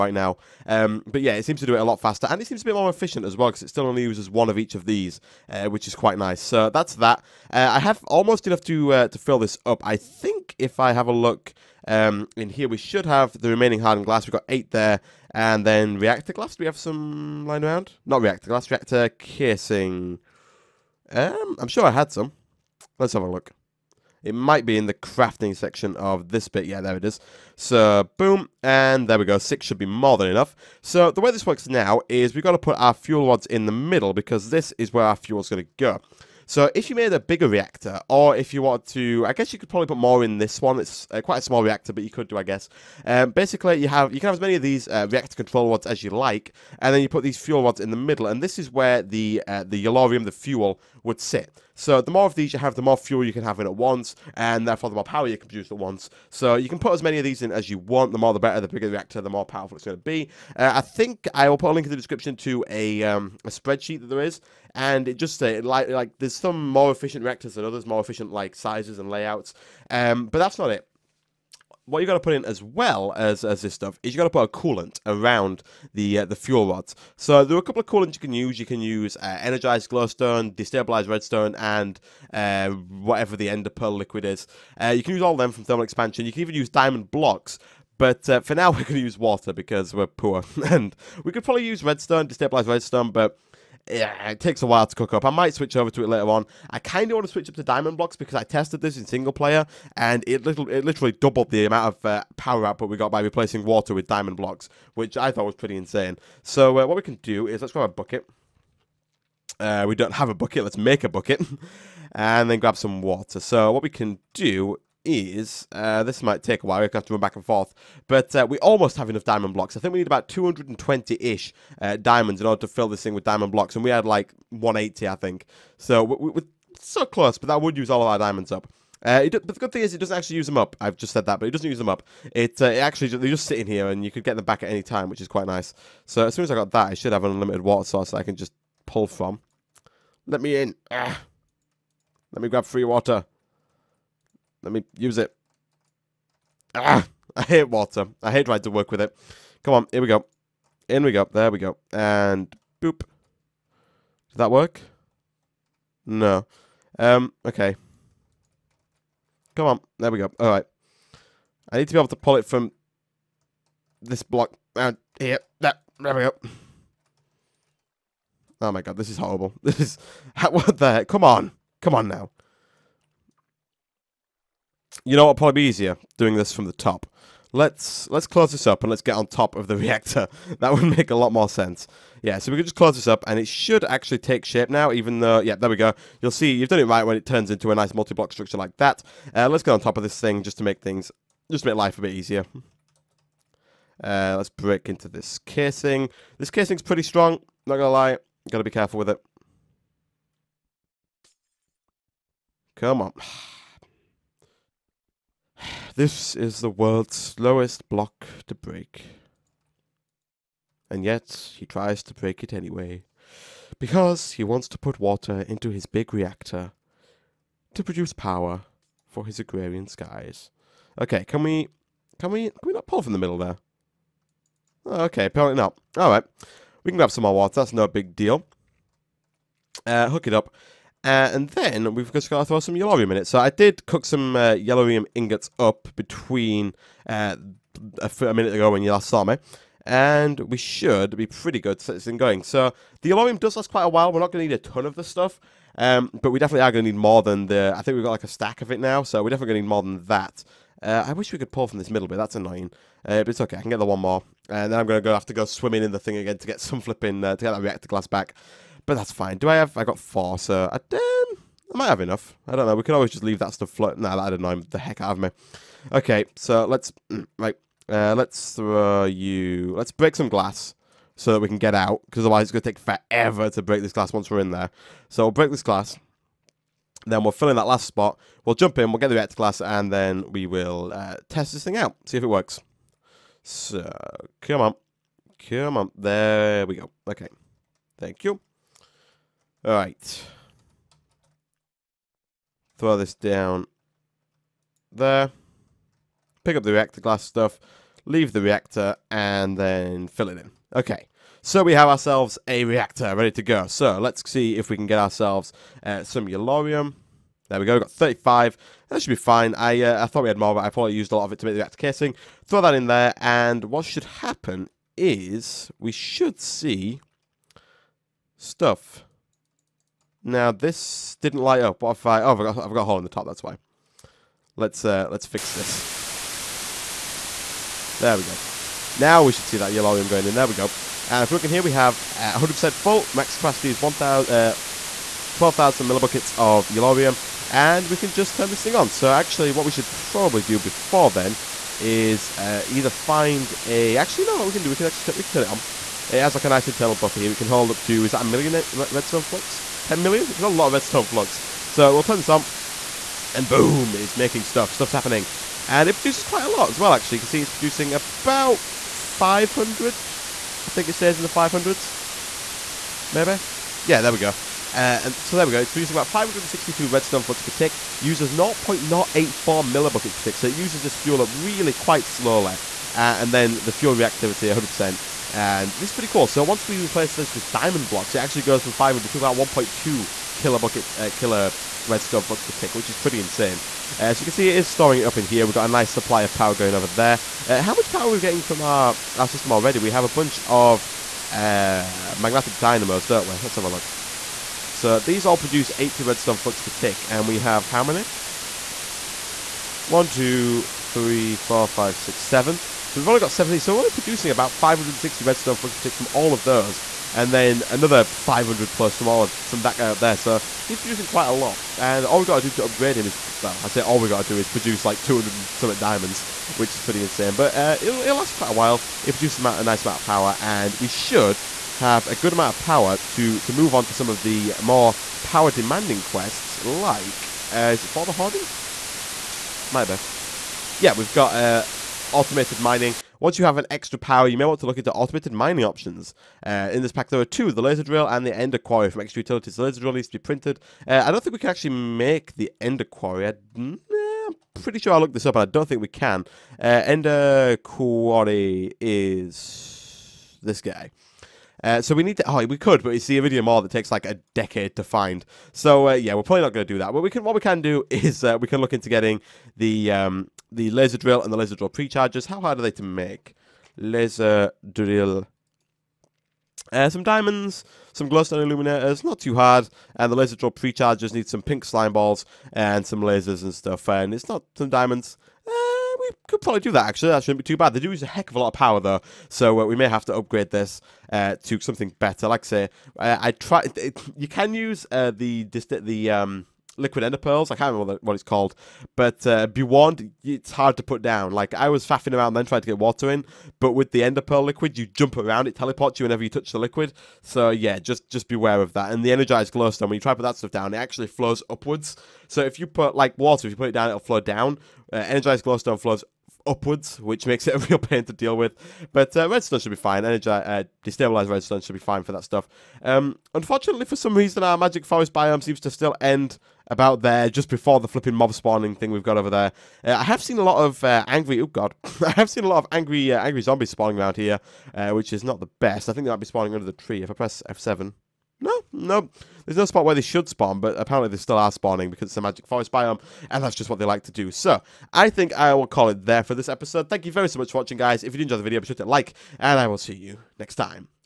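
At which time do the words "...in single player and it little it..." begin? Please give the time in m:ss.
1:38.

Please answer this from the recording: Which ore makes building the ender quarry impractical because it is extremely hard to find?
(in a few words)
Iridium ore.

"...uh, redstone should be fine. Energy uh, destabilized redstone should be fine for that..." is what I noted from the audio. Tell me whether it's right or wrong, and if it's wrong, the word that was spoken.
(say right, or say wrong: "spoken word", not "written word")
right.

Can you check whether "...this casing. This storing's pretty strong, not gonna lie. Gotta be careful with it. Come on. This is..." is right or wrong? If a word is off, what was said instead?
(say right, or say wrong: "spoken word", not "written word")
wrong: "casing", not "storing".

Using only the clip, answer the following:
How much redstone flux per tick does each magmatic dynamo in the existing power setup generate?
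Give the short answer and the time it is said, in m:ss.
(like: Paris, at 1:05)
80, at 6:35.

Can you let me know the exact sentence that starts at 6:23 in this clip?
Uh, so you can see it is storing it up in here.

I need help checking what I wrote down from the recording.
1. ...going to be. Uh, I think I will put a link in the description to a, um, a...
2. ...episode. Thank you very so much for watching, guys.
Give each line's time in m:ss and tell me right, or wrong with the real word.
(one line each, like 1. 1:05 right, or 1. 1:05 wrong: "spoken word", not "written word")
1. 0:59 right
2. 8:56 right.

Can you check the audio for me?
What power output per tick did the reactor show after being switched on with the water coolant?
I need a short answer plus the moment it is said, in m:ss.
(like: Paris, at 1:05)
562 redstone flux per tick, at 6:06.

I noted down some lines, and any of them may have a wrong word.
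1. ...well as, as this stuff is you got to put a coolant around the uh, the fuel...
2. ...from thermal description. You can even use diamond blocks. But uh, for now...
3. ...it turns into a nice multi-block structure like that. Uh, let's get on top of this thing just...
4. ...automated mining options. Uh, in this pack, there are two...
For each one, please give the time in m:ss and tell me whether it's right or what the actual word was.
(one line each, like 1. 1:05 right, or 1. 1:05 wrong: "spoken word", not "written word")
1. 1:12 right
2. 1:25 wrong: "expansion", not "description"
3. 3:07 right
4. 7:14 right.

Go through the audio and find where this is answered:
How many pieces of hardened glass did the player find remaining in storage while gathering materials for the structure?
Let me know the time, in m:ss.
0:14.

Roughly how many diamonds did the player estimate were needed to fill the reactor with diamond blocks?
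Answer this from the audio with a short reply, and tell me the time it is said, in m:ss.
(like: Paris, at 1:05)
220, at 2:00.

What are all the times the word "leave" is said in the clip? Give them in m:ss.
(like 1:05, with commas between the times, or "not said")
4:23, 4:58.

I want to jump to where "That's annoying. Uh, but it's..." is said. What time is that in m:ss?
4:12.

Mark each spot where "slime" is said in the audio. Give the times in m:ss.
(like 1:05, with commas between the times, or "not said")
7:51.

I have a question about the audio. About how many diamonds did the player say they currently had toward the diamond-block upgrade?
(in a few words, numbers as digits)
180.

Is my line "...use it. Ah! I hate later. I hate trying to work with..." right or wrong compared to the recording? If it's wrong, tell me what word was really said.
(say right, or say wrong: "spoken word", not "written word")
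wrong: "water", not "later".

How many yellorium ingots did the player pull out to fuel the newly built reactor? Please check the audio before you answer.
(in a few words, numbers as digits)
35.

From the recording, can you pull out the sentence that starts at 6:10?
So it uses this fuel up really quite slowly.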